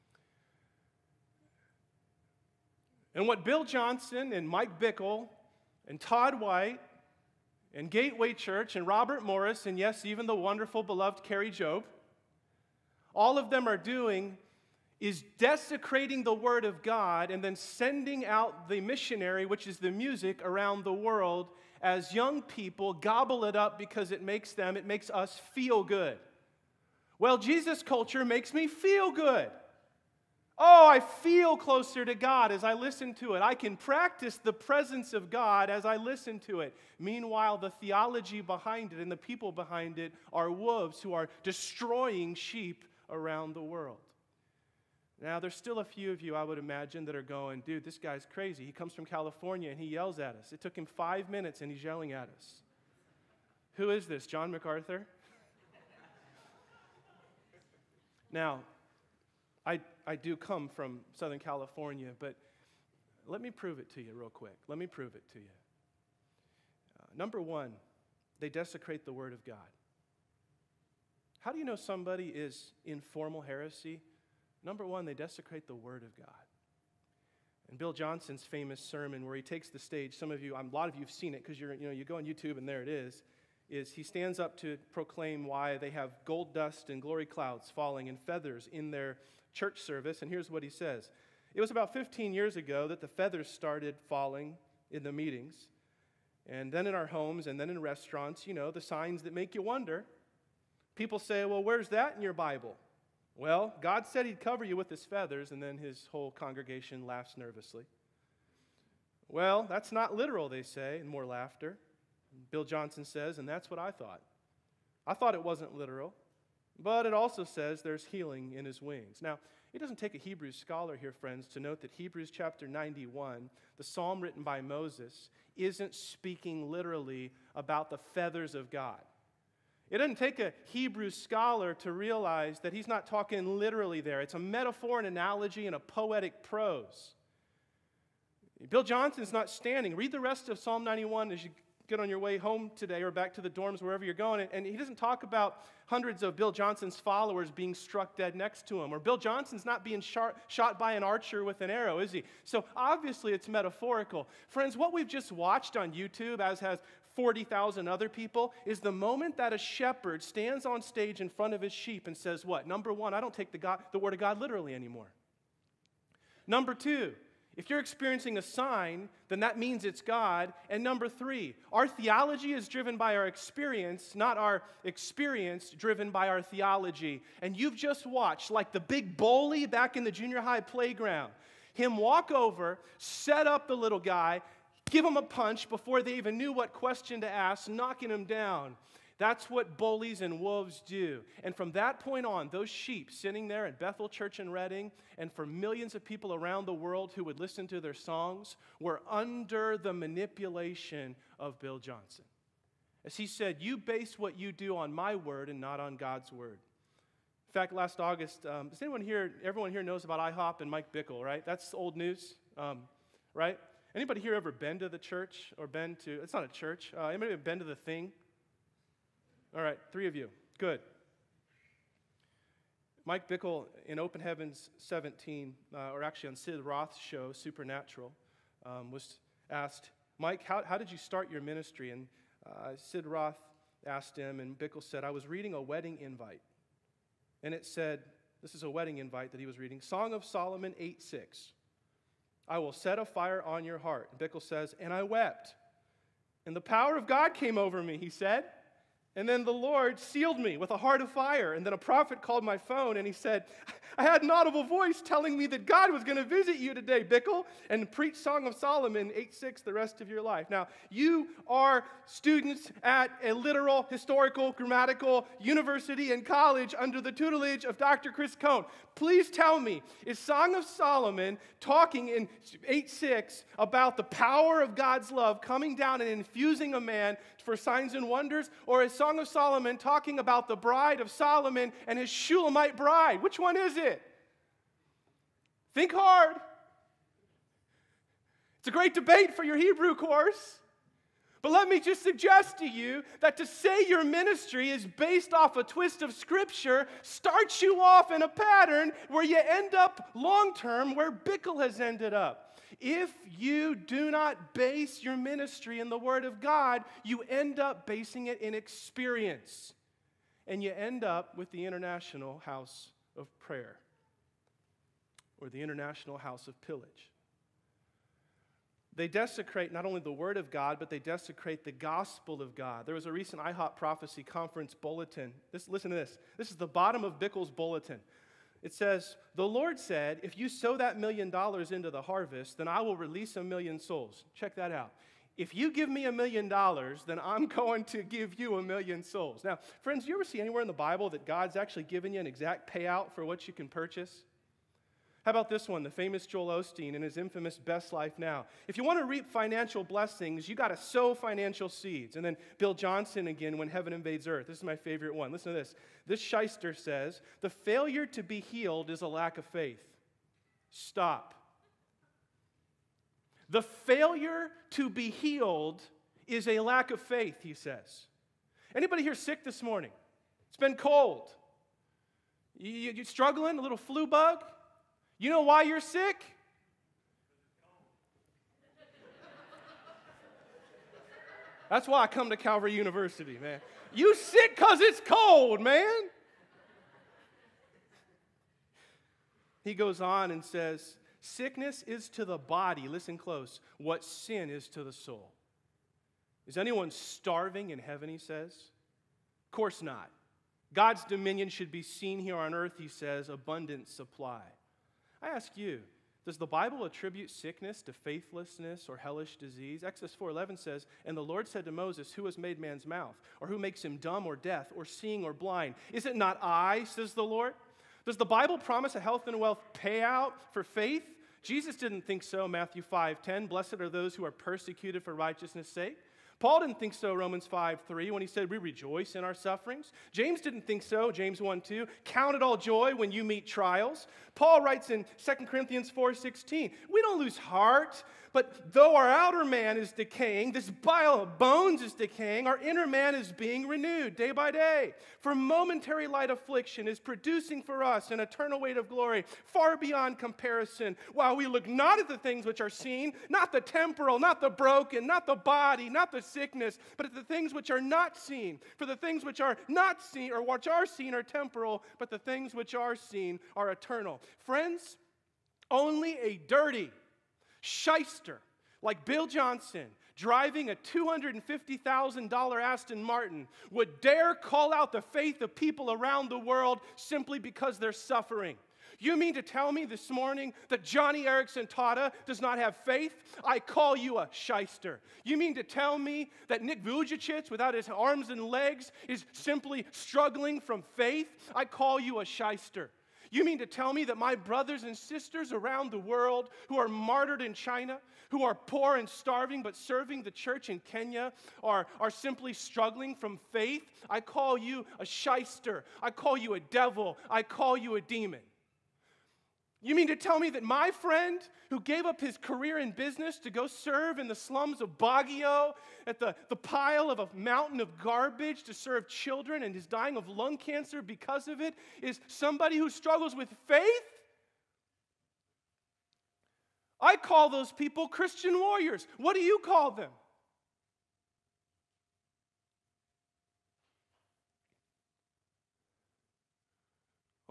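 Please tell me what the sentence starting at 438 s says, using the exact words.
But though our outer man is decaying, this bile of bones is decaying, our inner man is being renewed day by day.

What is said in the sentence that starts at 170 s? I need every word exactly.
And number three, our theology is driven by our experience, not our experience driven by our theology.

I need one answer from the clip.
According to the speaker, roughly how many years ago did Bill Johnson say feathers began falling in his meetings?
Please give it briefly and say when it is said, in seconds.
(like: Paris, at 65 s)
15, at 91 s.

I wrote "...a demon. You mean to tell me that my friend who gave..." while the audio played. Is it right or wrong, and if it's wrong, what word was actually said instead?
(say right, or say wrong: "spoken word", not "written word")
right.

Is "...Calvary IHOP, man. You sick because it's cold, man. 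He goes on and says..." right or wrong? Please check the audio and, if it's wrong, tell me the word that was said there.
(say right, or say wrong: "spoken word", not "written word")
wrong: "University", not "IHOP".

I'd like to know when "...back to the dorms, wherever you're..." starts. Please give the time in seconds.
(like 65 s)
143 s.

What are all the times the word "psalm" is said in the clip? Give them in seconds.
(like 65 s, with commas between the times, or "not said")
123 s, 140 s.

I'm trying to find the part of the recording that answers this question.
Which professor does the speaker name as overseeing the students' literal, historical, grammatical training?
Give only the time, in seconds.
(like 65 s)
267 s.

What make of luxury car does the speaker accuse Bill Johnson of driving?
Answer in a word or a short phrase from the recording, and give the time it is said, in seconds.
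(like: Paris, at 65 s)
Aston Martin, at 472 s.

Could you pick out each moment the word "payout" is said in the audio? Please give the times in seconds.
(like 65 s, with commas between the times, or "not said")
342 s, 419 s.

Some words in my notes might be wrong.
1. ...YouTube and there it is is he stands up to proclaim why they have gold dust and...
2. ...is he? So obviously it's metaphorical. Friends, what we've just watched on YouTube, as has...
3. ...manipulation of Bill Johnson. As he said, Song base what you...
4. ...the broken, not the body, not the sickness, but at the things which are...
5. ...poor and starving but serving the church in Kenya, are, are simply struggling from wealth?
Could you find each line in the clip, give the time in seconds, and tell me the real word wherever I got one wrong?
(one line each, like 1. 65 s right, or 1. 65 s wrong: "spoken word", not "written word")
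1. 82 s right
2. 151 s right
3. 199 s wrong: "You", not "Song"
4. 454 s right
5. 498 s wrong: "faith", not "wealth".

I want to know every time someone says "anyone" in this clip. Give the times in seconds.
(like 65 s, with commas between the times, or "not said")
208 s, 396 s.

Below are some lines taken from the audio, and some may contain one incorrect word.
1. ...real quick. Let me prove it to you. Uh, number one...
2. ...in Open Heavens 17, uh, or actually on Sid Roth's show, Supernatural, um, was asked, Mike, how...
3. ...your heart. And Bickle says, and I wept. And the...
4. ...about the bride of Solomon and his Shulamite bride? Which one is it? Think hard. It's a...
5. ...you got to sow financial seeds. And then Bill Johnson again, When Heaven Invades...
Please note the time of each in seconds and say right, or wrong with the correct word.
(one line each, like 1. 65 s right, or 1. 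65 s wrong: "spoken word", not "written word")
1. 64 s right
2. 223 s right
3. 243 s right
4. 280 s right
5. 350 s right.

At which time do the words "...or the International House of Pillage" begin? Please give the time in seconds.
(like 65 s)
315 s.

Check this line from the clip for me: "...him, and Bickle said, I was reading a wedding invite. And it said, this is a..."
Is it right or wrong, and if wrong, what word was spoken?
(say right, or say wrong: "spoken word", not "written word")
right.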